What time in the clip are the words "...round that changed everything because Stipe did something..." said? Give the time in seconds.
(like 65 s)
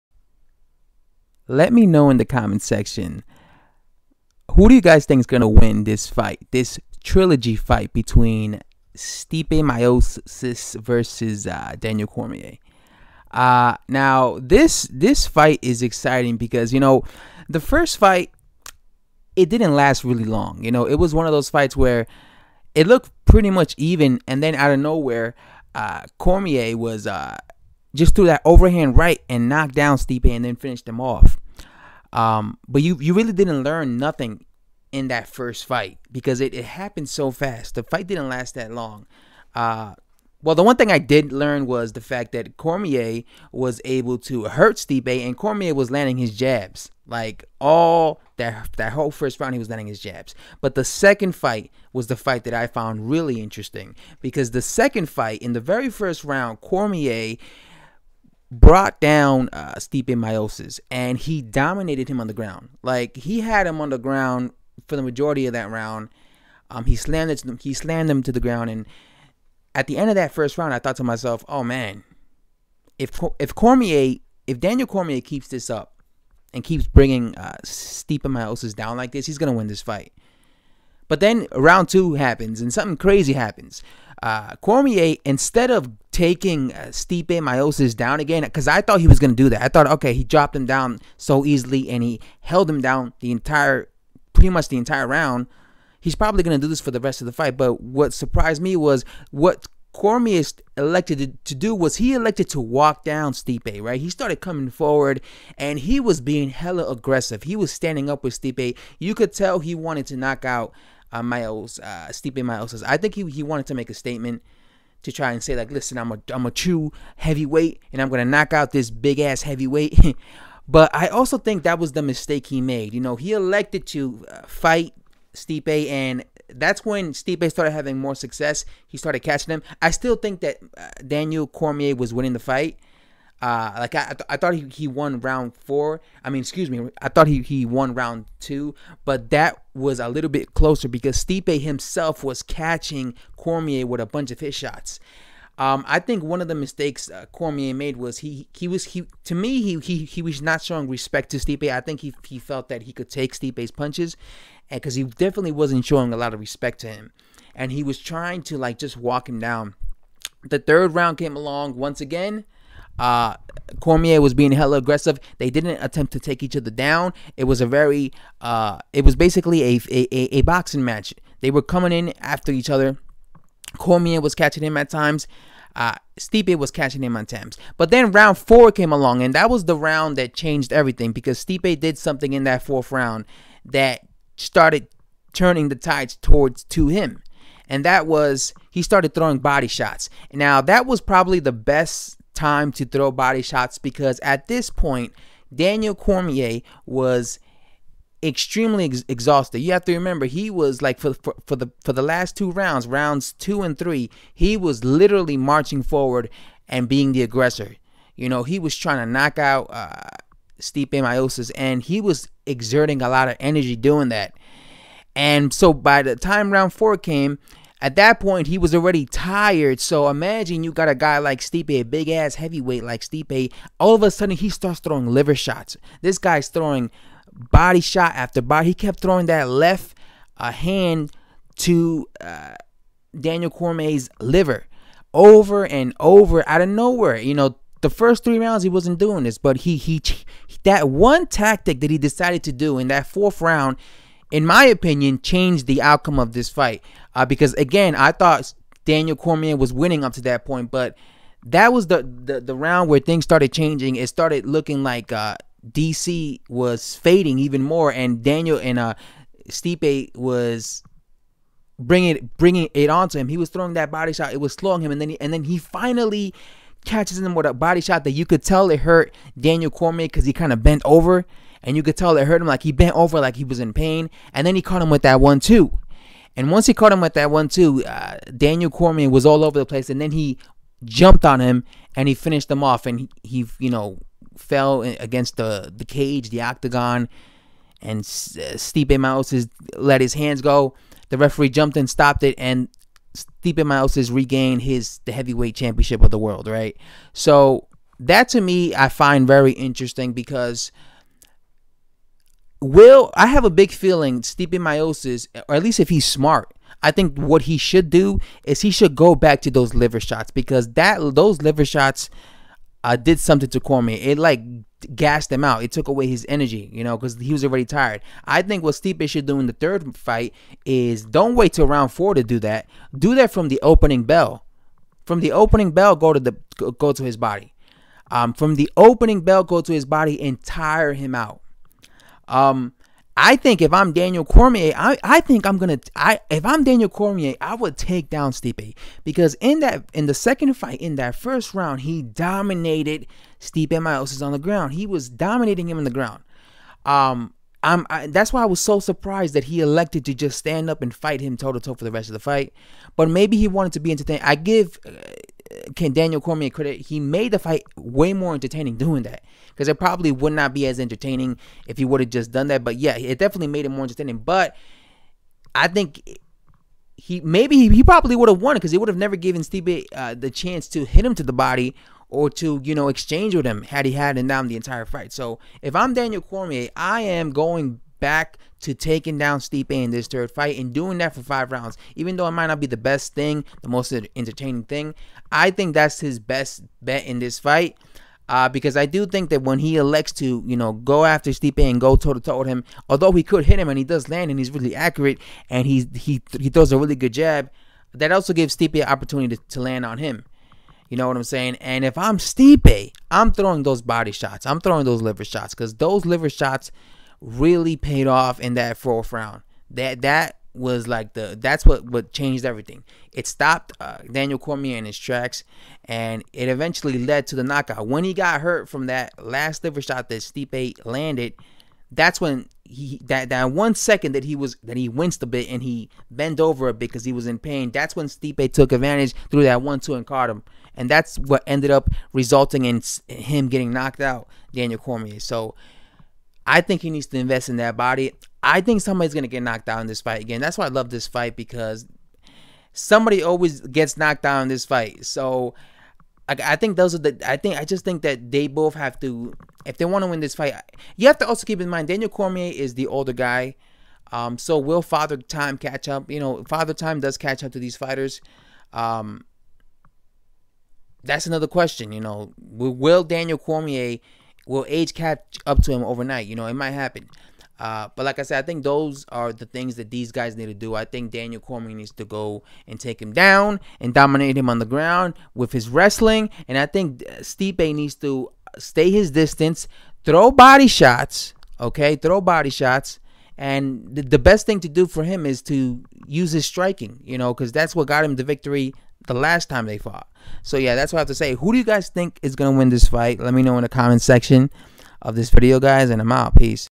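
179 s.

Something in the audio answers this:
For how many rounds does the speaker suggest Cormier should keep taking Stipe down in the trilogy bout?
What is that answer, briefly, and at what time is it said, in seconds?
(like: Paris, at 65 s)
5, at 381 s.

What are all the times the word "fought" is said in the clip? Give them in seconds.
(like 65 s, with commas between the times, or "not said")
489 s.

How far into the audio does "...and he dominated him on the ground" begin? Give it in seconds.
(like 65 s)
60 s.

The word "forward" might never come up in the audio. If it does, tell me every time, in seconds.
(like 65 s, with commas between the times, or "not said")
104 s, 205 s.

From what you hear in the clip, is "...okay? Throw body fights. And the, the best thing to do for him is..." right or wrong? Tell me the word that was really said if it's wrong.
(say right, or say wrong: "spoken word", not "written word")
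wrong: "shots", not "fights".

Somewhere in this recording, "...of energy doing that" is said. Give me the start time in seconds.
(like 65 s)
213 s.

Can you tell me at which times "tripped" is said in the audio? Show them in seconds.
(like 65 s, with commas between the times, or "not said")
not said.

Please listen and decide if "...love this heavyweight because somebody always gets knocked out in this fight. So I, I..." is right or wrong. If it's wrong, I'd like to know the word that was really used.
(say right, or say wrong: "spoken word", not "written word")
wrong: "fight", not "heavyweight".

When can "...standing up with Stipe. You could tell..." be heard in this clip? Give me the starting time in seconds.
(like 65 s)
107 s.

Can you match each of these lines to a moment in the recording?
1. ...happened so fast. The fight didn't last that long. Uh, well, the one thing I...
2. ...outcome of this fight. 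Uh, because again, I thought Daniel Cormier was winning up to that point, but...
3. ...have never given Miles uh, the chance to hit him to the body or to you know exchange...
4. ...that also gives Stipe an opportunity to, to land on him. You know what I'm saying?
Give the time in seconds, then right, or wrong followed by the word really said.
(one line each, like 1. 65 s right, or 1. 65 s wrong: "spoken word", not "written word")
1. 36 s right
2. 245 s right
3. 368 s wrong: "Stipe", not "Miles"
4. 397 s right.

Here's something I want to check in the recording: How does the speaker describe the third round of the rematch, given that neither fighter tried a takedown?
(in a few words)
a boxing match.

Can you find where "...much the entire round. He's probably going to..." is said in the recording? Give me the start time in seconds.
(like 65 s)
94 s.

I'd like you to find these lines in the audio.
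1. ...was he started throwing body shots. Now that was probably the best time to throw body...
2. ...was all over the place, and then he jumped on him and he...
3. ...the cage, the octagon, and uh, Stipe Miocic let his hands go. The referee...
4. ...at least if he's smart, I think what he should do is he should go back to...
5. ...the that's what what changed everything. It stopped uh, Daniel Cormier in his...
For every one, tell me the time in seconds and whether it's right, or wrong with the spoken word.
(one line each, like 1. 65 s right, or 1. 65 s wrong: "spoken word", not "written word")
1. 188 s right
2. 279 s right
3. 285 s right
4. 305 s right
5. 411 s right.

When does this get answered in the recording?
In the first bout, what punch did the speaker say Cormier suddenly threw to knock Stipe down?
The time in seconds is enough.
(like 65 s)
28 s.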